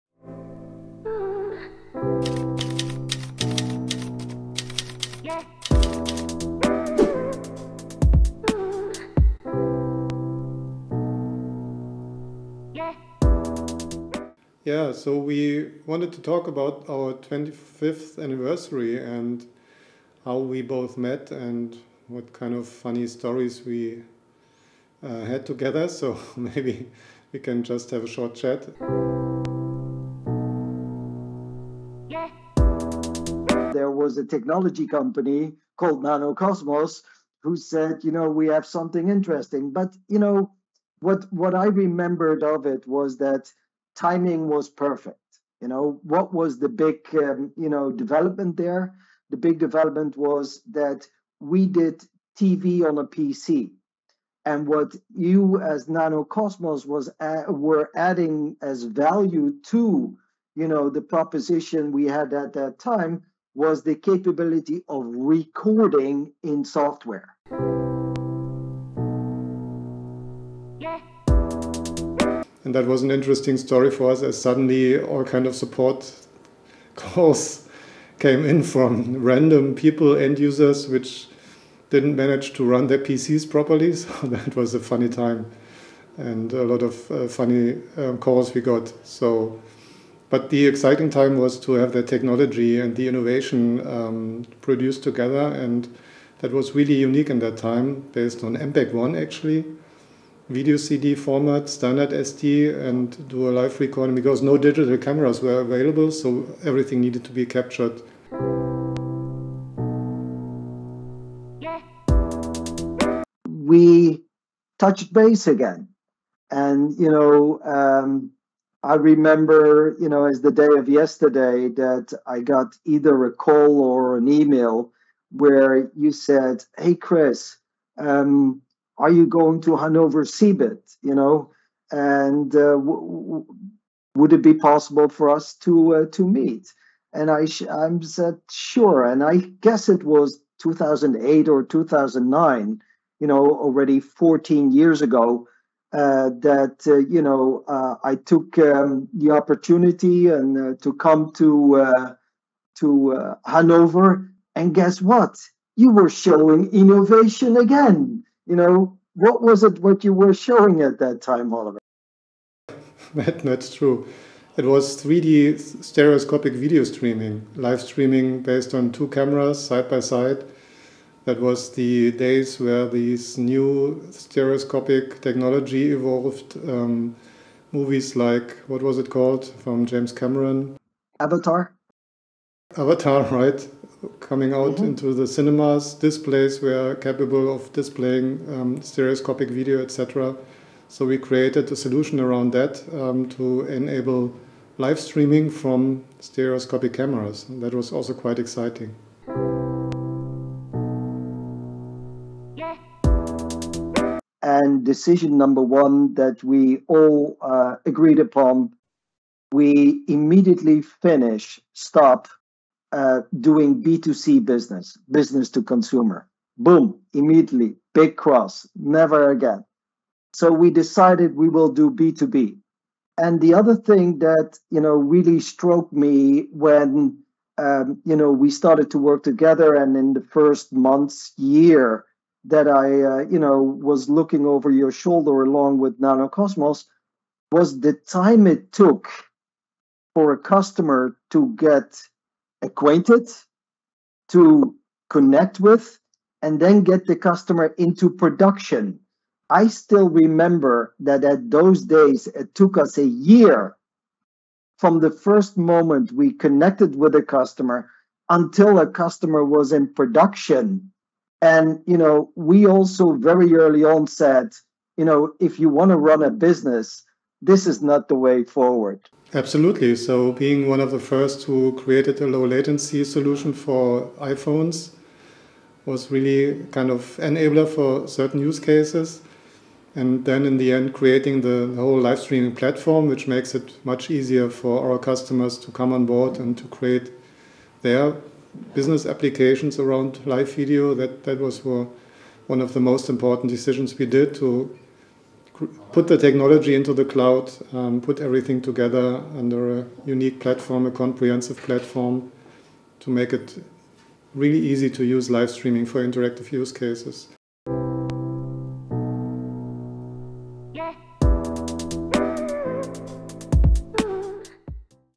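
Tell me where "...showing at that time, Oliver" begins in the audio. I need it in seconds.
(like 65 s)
160 s.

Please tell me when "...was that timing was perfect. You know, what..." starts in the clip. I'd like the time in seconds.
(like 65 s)
42 s.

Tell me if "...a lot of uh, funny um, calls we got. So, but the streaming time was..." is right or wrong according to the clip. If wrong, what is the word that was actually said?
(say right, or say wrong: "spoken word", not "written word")
wrong: "exciting", not "streaming".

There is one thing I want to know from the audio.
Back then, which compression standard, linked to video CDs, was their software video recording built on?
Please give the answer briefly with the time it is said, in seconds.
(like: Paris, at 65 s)
MPEG One, at 98 s.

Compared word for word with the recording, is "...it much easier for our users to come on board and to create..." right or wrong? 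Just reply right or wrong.
wrong.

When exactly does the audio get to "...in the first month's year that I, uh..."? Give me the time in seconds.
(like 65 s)
229 s.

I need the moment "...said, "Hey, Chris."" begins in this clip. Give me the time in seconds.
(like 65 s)
126 s.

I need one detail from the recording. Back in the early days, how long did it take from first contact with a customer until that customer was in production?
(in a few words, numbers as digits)
A year.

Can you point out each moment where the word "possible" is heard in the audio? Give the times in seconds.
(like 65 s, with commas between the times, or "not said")
134 s.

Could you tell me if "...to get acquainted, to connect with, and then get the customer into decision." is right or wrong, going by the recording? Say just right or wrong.
wrong.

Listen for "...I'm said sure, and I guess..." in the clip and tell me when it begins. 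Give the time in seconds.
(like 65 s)
137 s.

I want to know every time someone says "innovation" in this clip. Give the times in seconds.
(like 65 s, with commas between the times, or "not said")
93 s, 156 s.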